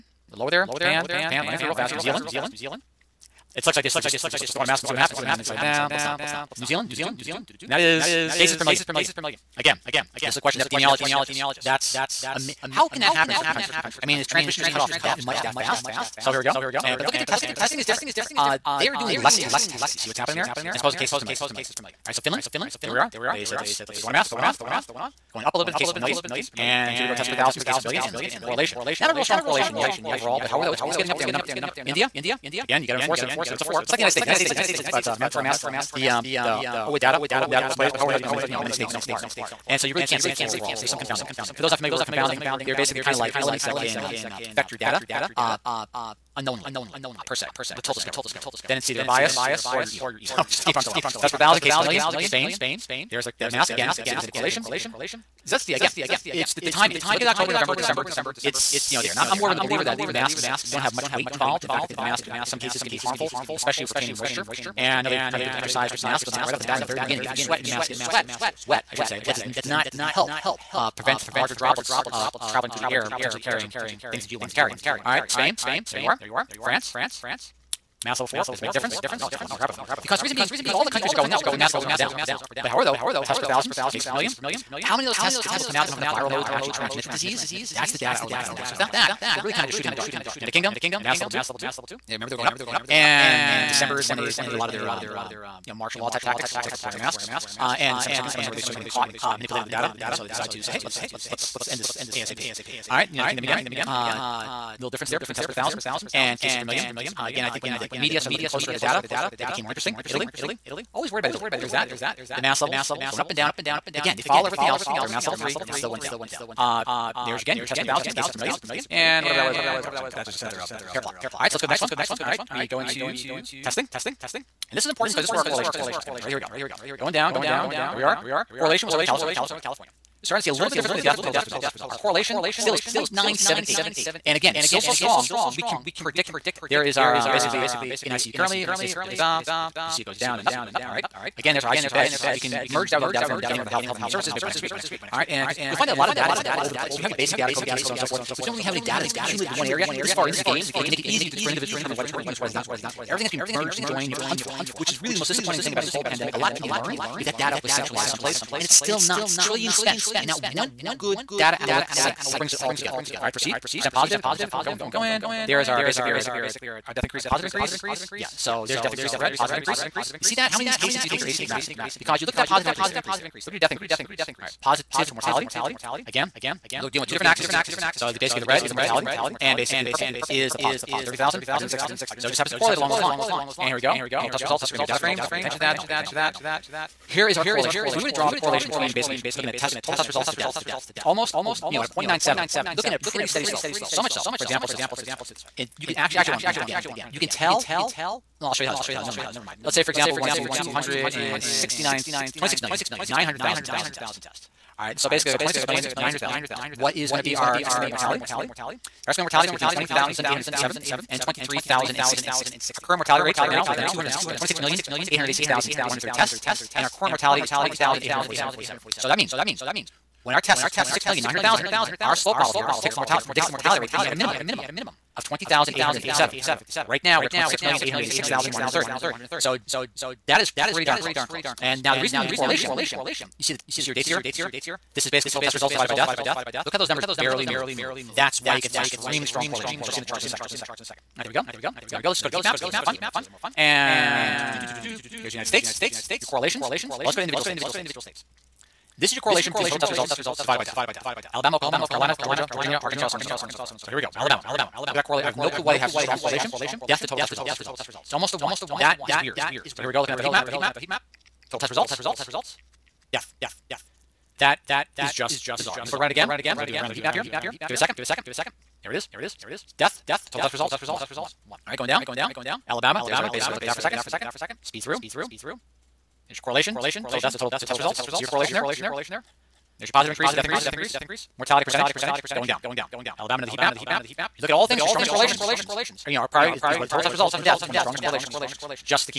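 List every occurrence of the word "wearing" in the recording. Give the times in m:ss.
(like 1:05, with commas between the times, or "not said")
1:36.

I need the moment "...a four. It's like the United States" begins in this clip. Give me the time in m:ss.
0:33.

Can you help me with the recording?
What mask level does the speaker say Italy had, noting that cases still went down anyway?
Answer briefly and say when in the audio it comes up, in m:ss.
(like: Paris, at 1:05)
3, at 1:55.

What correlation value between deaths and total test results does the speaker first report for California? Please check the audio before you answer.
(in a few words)
0.978.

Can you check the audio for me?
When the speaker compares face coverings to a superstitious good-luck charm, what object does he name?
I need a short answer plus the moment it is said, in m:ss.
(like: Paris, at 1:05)
lucky rabbit foot, at 1:19.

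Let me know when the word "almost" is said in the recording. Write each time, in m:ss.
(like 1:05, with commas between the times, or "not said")
3:11, 4:18.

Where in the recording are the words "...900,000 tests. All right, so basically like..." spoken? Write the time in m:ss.
3:23.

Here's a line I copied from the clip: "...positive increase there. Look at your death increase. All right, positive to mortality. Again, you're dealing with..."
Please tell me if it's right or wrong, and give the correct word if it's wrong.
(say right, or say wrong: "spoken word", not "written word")
right.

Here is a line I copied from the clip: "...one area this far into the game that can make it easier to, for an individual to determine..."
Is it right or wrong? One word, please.
right.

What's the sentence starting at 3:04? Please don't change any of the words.
This is going to be a data frame.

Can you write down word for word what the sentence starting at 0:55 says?
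That's the again, it's the, the timing.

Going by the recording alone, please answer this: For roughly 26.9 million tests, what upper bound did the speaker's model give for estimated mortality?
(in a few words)
23,060.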